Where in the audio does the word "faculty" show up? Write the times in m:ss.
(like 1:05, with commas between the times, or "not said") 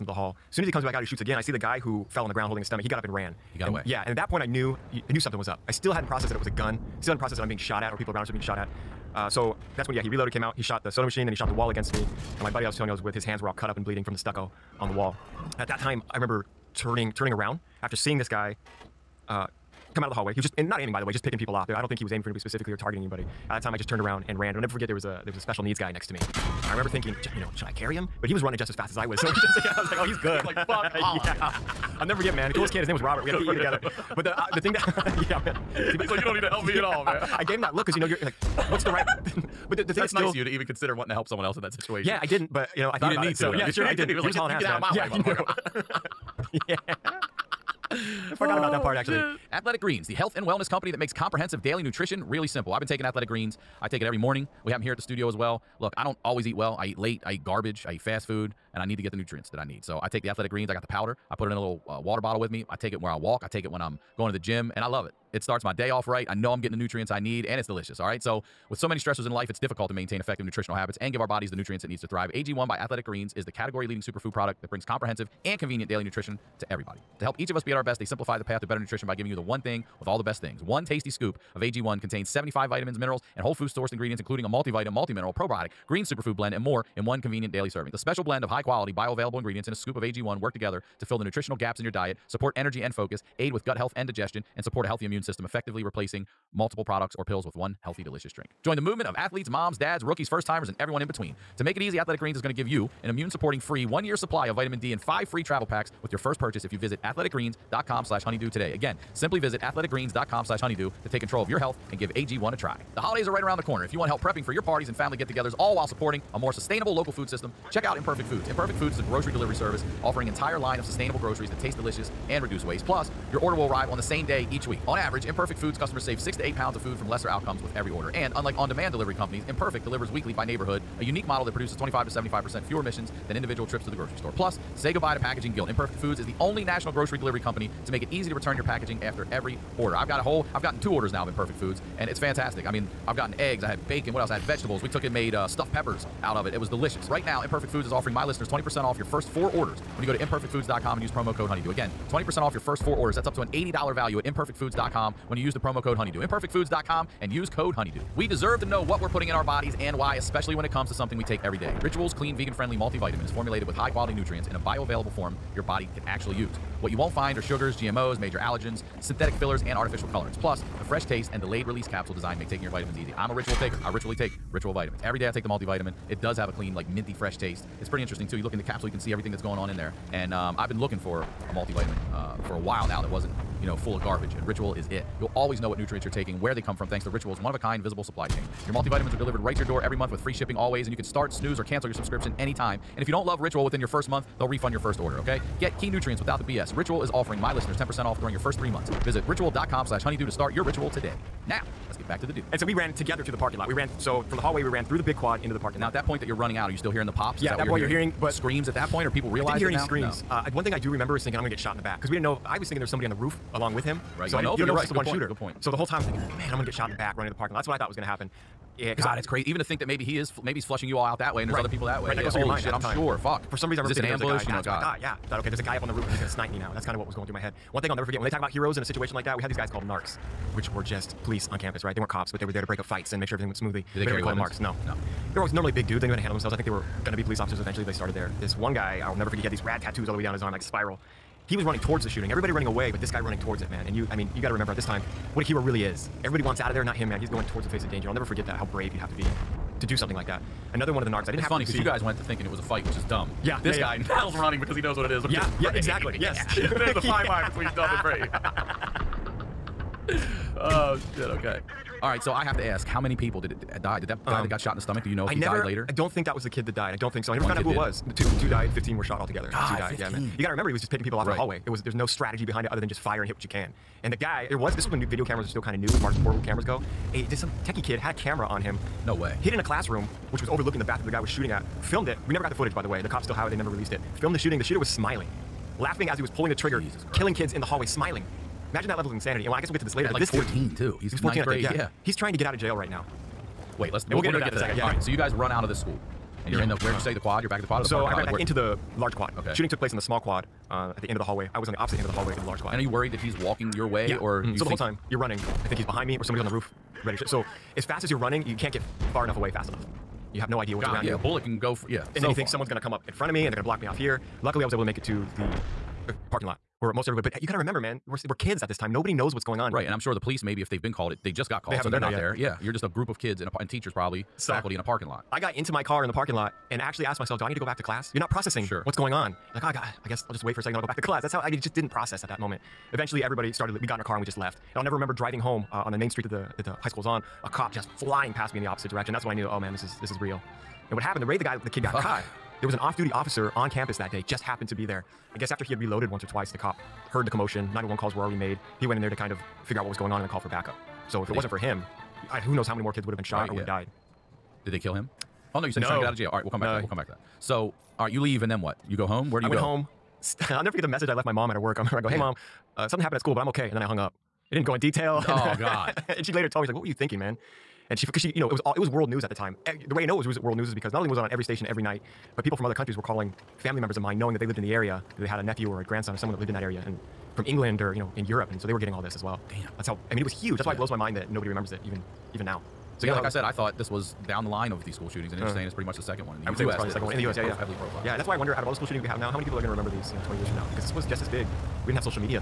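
5:24.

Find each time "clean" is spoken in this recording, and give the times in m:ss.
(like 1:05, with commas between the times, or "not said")
2:42, 2:56.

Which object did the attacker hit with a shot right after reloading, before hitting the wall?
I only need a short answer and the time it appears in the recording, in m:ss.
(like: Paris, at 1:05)
the soda machine, at 0:10.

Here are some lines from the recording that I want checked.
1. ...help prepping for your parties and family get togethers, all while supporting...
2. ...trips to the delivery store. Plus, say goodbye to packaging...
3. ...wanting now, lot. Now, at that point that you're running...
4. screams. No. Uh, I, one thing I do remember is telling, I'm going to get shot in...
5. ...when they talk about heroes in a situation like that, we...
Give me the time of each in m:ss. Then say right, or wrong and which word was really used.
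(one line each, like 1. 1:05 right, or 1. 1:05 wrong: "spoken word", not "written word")
1. 1:54 right
2. 2:13 wrong: "grocery", not "delivery"
3. 3:25 wrong: "parking", not "wanting"
4. 3:29 wrong: "thinking", not "telling"
5. 3:48 right.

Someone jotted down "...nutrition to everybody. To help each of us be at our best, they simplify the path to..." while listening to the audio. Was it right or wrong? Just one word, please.
right.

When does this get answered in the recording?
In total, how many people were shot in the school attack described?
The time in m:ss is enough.
4:28.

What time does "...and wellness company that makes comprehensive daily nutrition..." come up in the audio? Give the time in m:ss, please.
0:50.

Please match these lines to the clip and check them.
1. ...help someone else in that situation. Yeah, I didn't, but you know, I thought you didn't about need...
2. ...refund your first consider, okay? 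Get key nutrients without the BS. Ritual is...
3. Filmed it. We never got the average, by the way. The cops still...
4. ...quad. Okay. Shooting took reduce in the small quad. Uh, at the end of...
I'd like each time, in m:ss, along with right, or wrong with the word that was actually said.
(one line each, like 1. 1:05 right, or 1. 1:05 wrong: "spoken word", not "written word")
1. 0:41 right
2. 3:14 wrong: "order", not "consider"
3. 4:41 wrong: "footage", not "average"
4. 4:59 wrong: "place", not "reduce".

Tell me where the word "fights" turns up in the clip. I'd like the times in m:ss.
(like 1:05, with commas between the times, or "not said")
3:52, 4:12.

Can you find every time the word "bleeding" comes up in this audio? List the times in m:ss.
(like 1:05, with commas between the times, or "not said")
0:13.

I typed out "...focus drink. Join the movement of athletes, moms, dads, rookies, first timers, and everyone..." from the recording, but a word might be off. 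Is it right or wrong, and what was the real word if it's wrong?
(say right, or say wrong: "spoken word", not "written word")
wrong: "delicious", not "focus".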